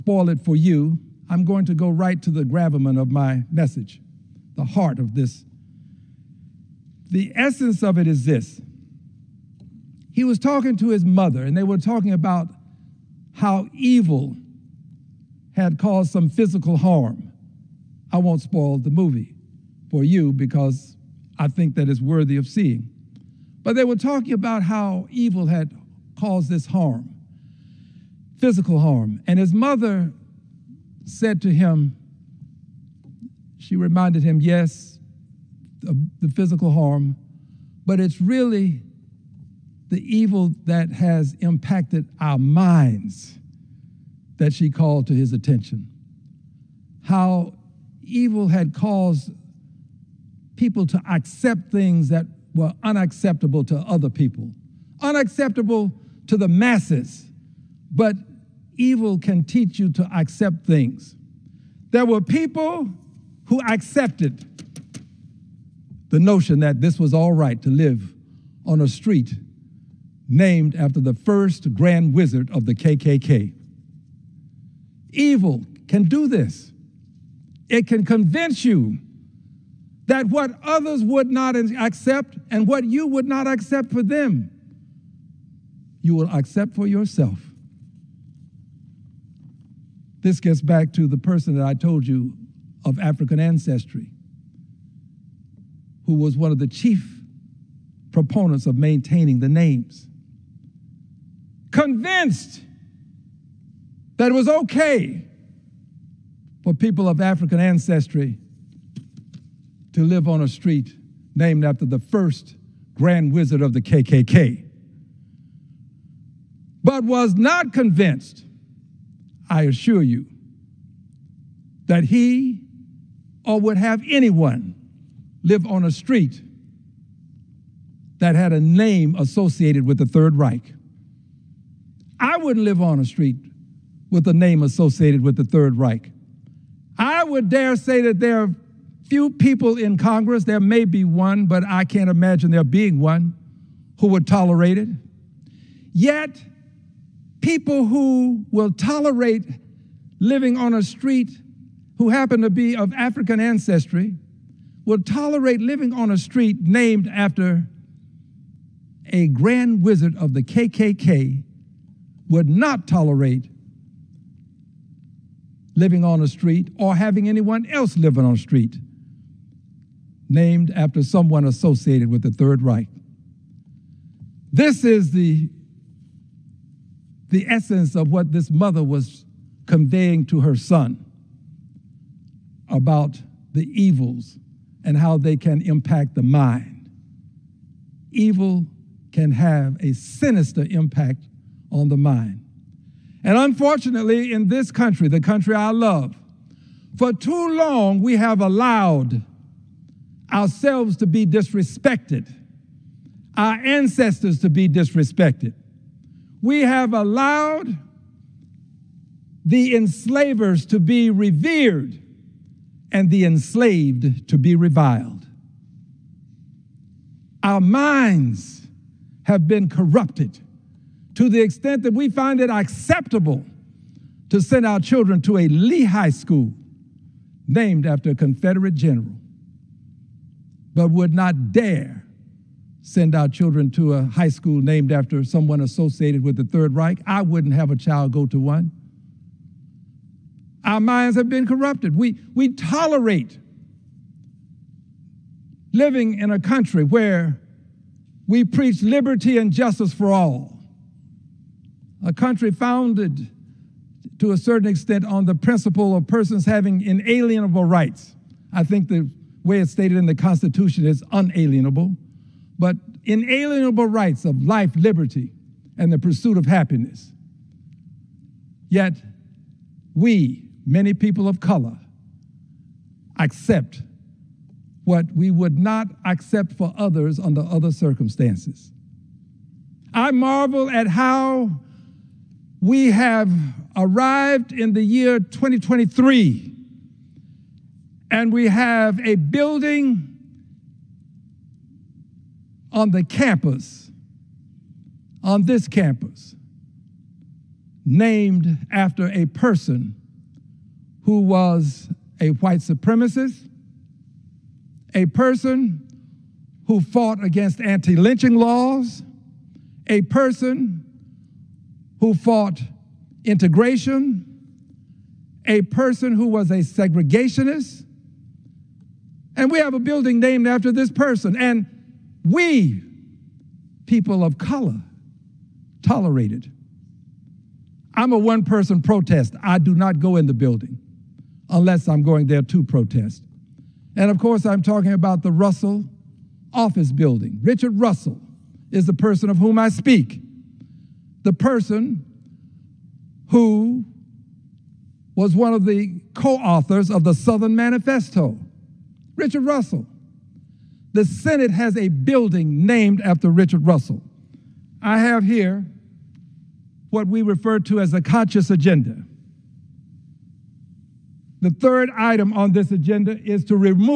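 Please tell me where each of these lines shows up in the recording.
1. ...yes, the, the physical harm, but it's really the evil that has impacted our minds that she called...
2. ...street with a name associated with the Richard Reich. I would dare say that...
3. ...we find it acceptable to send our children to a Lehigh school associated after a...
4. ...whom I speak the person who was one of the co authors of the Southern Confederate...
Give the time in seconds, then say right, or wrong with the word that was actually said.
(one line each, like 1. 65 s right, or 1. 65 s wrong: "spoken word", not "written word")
1. 34 s right
2. 133 s wrong: "Third", not "Richard"
3. 221 s wrong: "named", not "associated"
4. 339 s wrong: "Manifesto", not "Confederate".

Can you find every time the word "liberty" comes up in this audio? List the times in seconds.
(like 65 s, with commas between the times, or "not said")
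248 s, 264 s.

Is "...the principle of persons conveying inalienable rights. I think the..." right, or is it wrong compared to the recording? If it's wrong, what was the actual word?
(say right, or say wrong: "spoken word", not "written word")
wrong: "having", not "conveying".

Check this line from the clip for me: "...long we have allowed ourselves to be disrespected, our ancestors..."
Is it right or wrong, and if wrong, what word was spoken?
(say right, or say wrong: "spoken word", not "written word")
right.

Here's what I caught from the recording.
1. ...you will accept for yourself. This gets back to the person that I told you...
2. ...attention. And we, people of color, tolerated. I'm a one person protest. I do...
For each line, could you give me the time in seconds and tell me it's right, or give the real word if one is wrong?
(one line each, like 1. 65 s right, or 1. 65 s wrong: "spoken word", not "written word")
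1. 86 s right
2. 320 s wrong: "person", not "attention".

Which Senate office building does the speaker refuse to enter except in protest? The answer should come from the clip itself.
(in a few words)
Russell office building.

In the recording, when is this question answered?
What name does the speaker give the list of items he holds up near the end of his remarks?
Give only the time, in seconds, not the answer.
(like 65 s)
358 s.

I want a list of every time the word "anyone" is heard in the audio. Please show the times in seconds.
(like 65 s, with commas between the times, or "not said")
124 s, 167 s.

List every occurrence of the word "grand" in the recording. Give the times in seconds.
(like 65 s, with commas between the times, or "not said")
71 s, 112 s, 159 s.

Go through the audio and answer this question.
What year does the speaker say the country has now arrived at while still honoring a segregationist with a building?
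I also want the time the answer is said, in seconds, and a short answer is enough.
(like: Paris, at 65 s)
2023, at 285 s.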